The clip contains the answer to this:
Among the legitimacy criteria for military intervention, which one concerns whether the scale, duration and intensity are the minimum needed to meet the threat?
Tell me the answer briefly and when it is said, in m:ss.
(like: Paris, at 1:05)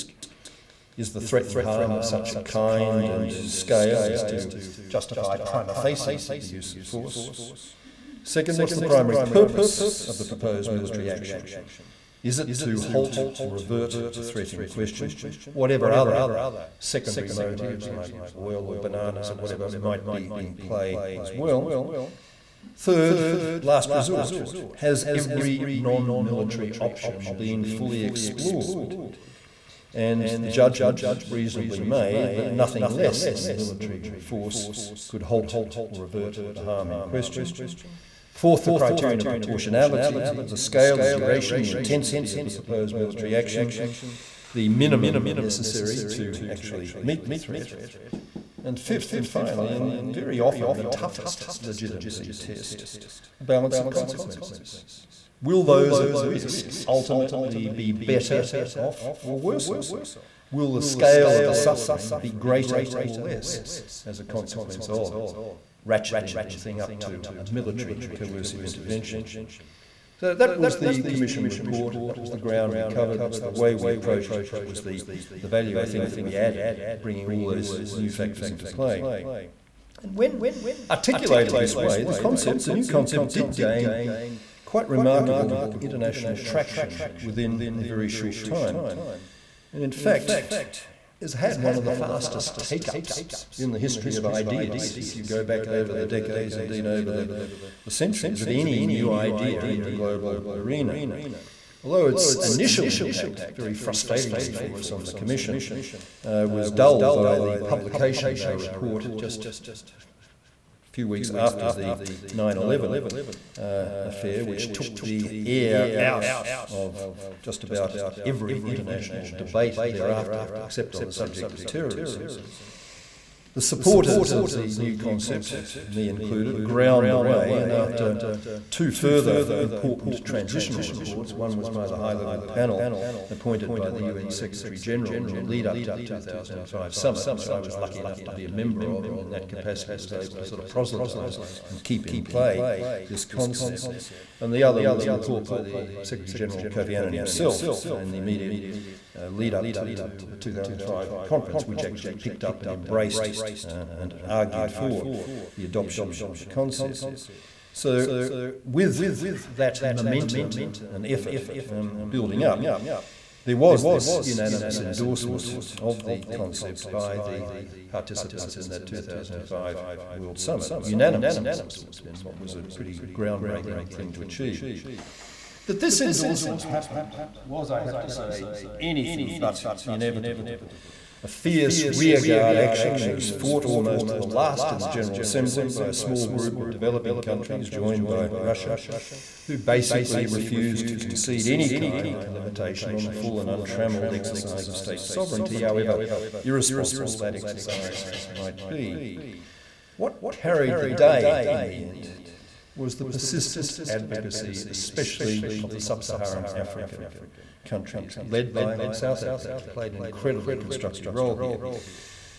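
proportionality, at 0:39.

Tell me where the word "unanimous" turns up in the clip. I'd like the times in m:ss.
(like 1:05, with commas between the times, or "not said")
2:44, 2:50.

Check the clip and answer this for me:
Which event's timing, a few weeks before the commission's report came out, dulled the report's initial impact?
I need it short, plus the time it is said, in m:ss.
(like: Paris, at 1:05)
9/11, at 1:52.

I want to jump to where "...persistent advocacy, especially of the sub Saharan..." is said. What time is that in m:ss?
3:23.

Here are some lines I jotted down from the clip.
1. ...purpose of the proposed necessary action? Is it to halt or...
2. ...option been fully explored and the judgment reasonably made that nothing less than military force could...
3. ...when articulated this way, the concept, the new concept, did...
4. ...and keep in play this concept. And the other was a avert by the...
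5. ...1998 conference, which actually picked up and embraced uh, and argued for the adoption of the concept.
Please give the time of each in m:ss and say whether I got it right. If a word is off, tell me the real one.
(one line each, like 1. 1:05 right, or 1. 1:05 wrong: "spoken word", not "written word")
1. 0:09 wrong: "military", not "necessary"
2. 0:26 right
3. 1:20 right
4. 2:21 wrong: "report", not "avert"
5. 2:30 wrong: "2005", not "1998".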